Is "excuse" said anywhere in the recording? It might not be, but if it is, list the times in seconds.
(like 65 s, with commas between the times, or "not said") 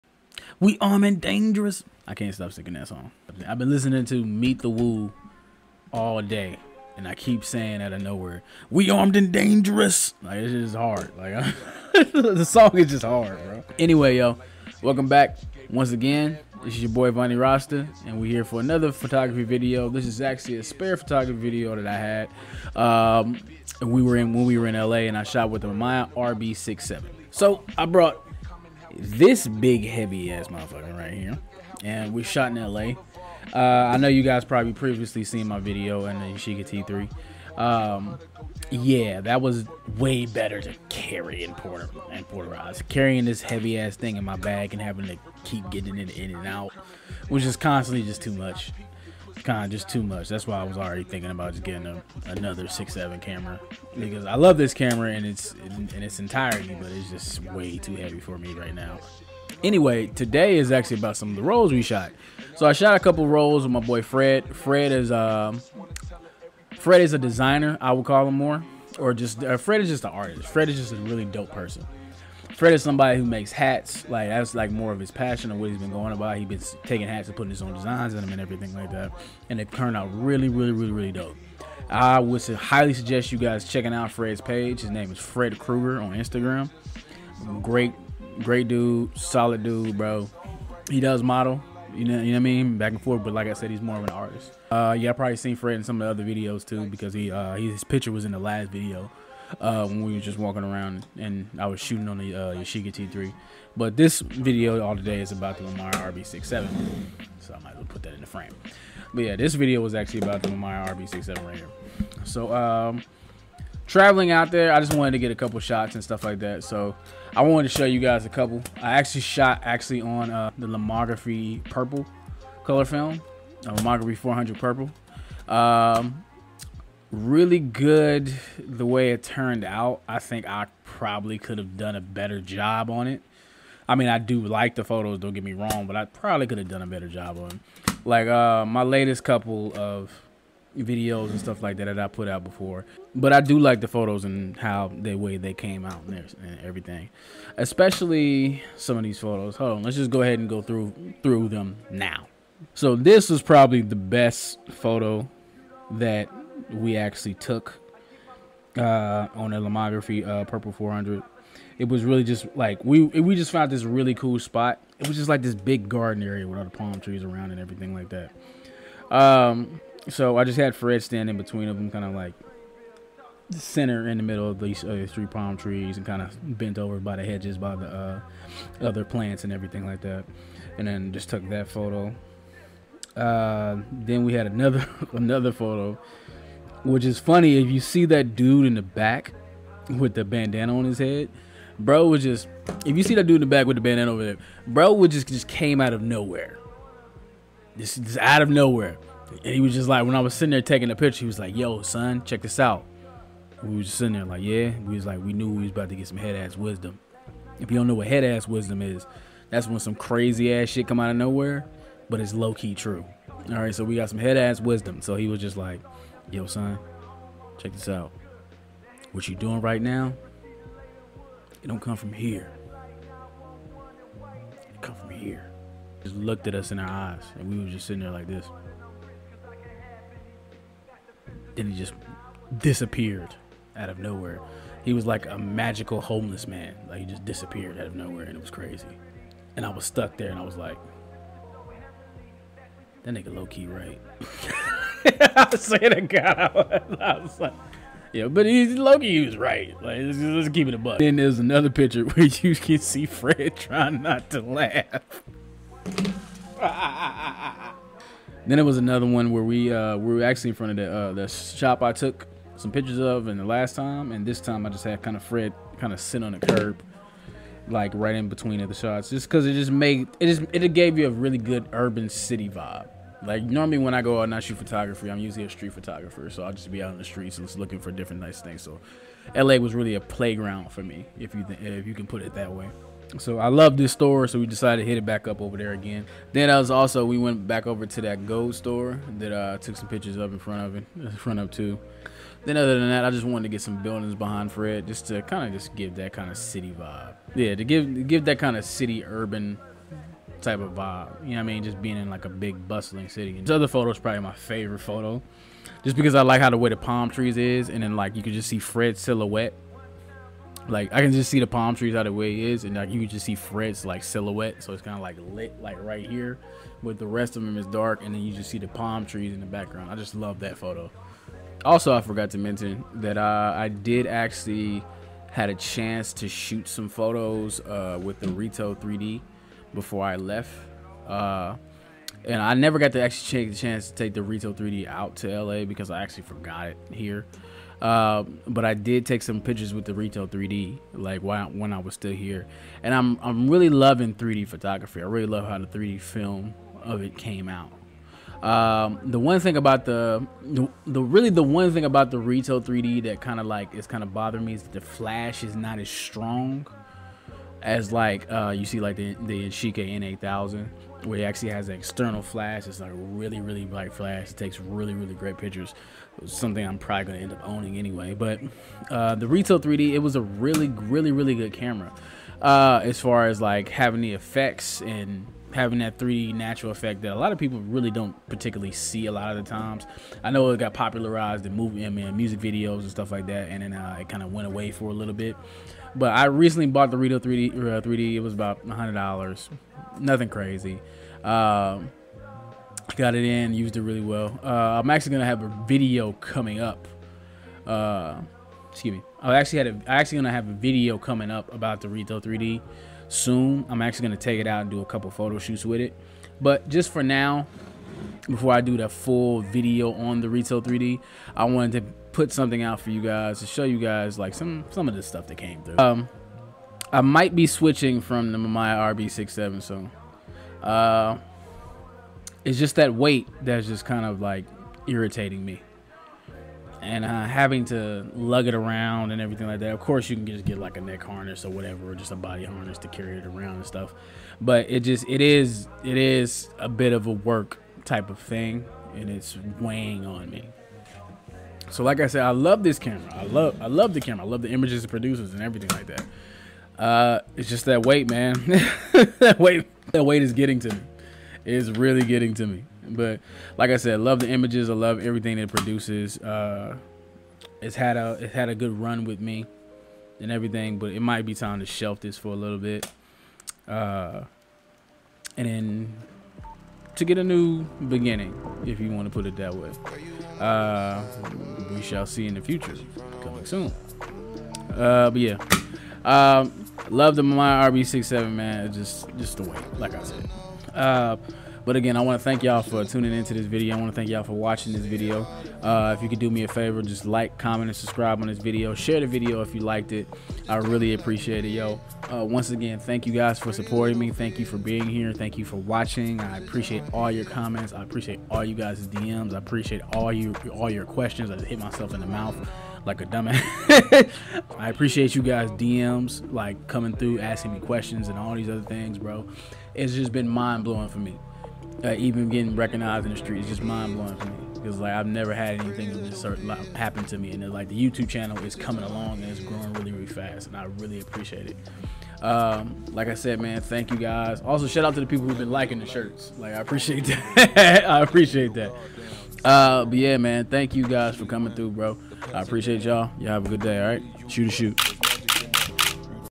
398 s.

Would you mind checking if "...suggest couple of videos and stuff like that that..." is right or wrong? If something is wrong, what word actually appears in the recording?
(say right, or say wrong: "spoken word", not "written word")
wrong: "latest", not "suggest".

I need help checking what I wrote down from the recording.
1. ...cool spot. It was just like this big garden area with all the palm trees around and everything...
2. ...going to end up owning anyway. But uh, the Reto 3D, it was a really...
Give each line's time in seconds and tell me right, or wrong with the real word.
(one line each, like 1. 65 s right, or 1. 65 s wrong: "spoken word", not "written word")
1. 164 s right
2. 367 s right.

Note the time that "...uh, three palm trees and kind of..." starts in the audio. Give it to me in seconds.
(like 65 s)
174 s.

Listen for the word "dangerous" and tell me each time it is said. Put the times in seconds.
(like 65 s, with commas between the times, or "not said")
1 s, 9 s.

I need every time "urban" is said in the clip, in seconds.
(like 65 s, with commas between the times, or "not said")
271 s, 299 s.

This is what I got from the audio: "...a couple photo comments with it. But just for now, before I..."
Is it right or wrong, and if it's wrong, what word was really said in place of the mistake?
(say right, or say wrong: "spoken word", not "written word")
wrong: "shoots", not "comments".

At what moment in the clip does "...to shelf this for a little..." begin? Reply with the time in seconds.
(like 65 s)
461 s.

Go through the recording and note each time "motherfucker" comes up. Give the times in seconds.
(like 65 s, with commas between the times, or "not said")
30 s.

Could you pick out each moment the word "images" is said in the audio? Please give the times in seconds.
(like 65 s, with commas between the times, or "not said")
444 s, 454 s.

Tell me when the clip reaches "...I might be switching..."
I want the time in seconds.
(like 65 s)
416 s.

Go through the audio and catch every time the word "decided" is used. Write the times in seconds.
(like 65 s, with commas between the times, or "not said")
284 s.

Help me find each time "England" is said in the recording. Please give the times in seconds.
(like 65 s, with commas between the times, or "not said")
not said.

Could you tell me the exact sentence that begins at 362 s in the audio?
It's like really really bright flash.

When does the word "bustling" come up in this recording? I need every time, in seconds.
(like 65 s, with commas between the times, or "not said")
302 s.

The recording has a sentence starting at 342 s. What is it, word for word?
And I'm I'm really loving 3D photography.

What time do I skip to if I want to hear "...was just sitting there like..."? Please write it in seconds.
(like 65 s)
203 s.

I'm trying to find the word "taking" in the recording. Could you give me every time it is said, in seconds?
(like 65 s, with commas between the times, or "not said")
76 s, 200 s.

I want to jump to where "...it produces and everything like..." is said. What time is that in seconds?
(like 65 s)
444 s.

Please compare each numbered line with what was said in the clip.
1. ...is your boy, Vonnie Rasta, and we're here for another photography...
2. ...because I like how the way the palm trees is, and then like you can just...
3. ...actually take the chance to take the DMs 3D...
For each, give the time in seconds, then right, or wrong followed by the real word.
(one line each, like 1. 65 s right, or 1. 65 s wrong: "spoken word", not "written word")
1. 16 s right
2. 305 s right
3. 333 s wrong: "Reto", not "DMs".